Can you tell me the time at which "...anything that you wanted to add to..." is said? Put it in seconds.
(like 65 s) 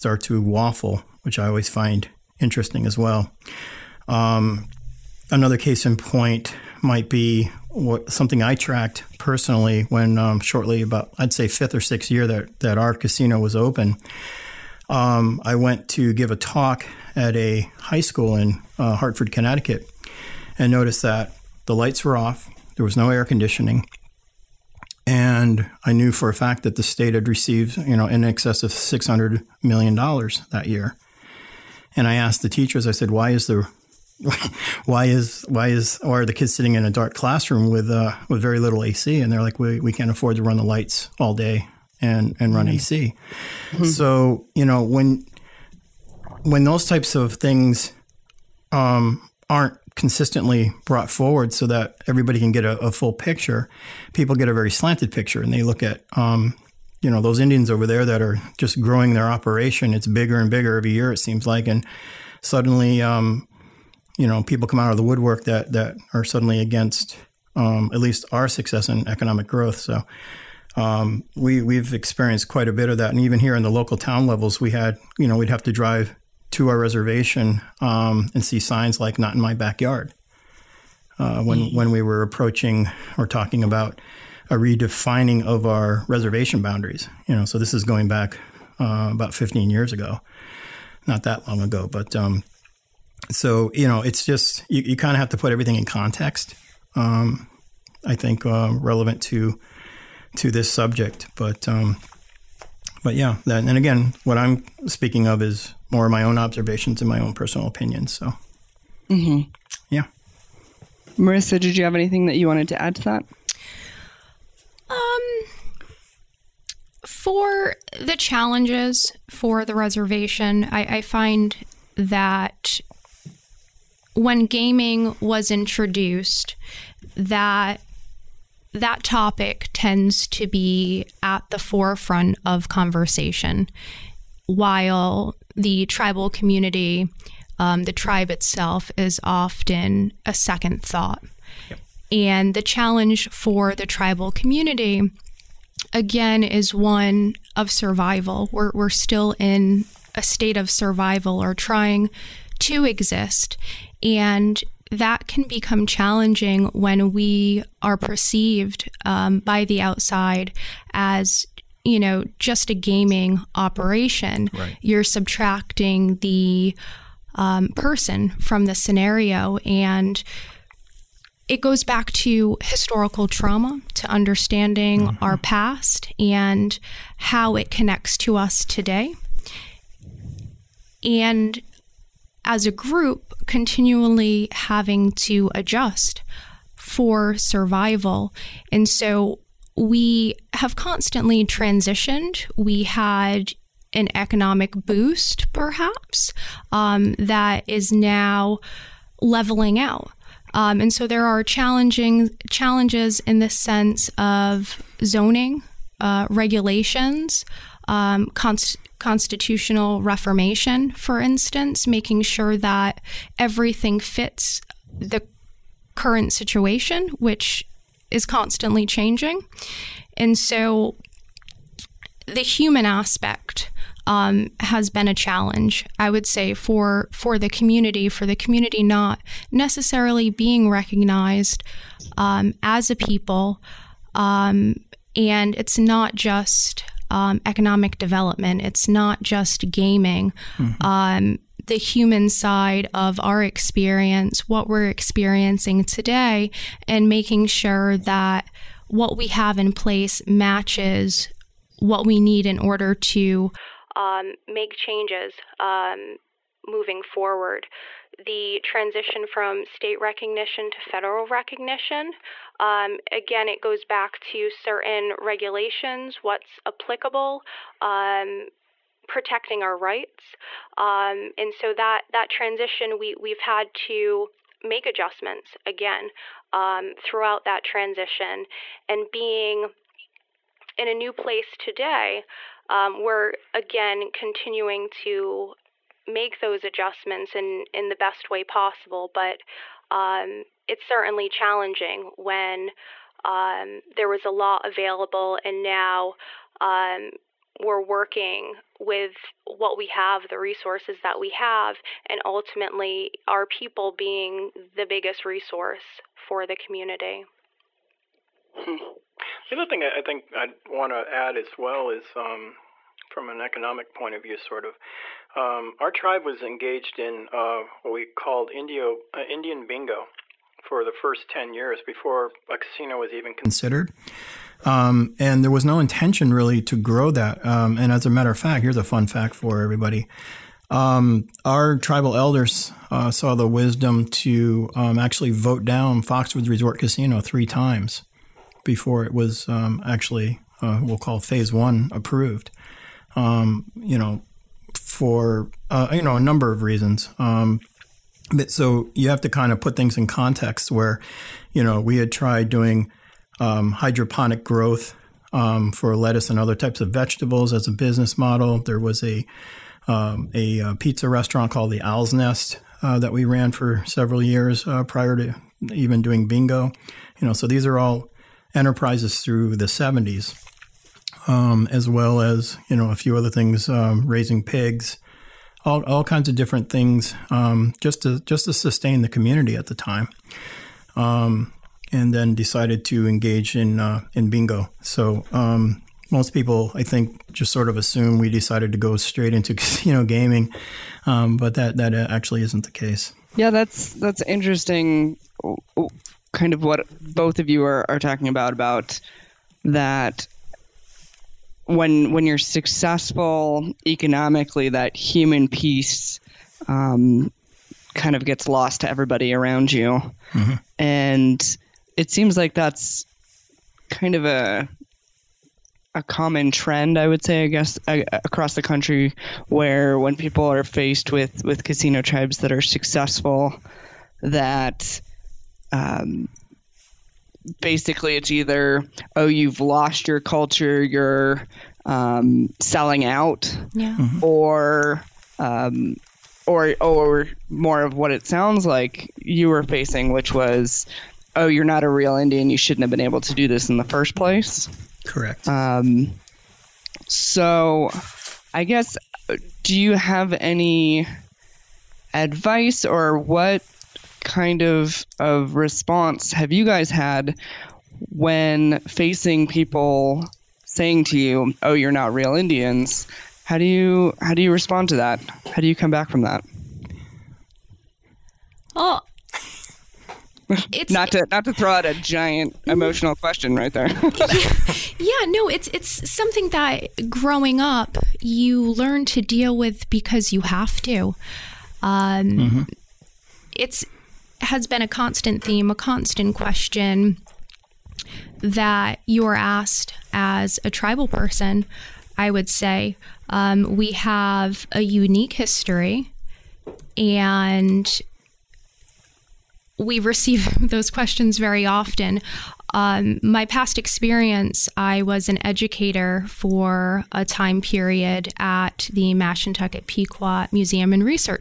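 111 s.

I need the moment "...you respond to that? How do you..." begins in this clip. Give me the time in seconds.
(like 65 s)
464 s.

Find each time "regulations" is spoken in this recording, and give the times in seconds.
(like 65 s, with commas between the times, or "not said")
206 s, 265 s.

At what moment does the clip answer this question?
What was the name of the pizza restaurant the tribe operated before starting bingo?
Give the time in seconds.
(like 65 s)
361 s.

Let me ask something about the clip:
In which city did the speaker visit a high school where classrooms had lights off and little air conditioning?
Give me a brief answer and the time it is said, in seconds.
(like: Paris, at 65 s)
Hartford, Connecticut, at 18 s.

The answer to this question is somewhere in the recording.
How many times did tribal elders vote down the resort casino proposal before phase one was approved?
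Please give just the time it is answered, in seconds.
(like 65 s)
337 s.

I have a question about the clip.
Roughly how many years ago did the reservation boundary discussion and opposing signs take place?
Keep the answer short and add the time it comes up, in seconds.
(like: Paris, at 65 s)
15 years, at 89 s.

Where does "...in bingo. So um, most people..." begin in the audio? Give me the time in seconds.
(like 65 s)
384 s.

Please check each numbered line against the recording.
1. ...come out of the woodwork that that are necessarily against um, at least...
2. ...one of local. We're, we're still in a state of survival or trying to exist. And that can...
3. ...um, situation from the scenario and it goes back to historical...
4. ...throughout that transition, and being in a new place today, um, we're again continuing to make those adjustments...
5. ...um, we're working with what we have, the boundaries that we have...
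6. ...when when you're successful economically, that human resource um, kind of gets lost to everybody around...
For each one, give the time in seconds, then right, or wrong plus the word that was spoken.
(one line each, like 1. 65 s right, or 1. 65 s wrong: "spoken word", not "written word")
1. 64 s wrong: "suddenly", not "necessarily"
2. 146 s wrong: "survival", not "local"
3. 167 s wrong: "person", not "situation"
4. 276 s right
5. 296 s wrong: "resources", not "boundaries"
6. 401 s wrong: "piece", not "resource".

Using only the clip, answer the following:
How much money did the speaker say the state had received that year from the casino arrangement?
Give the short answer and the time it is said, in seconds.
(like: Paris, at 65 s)
over $600 million, at 28 s.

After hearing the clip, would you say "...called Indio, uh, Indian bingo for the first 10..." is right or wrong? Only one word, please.
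right.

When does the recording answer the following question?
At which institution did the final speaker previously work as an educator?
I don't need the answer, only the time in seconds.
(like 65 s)
509 s.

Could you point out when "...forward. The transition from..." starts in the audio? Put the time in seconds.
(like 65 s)
257 s.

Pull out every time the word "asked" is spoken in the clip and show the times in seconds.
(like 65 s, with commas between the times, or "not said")
32 s, 489 s.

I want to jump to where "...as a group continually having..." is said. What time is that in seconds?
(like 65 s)
182 s.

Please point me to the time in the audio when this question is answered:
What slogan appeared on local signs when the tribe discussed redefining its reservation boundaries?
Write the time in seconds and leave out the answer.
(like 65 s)
79 s.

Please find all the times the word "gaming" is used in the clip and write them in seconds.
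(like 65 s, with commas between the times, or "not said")
124 s, 162 s, 239 s, 390 s.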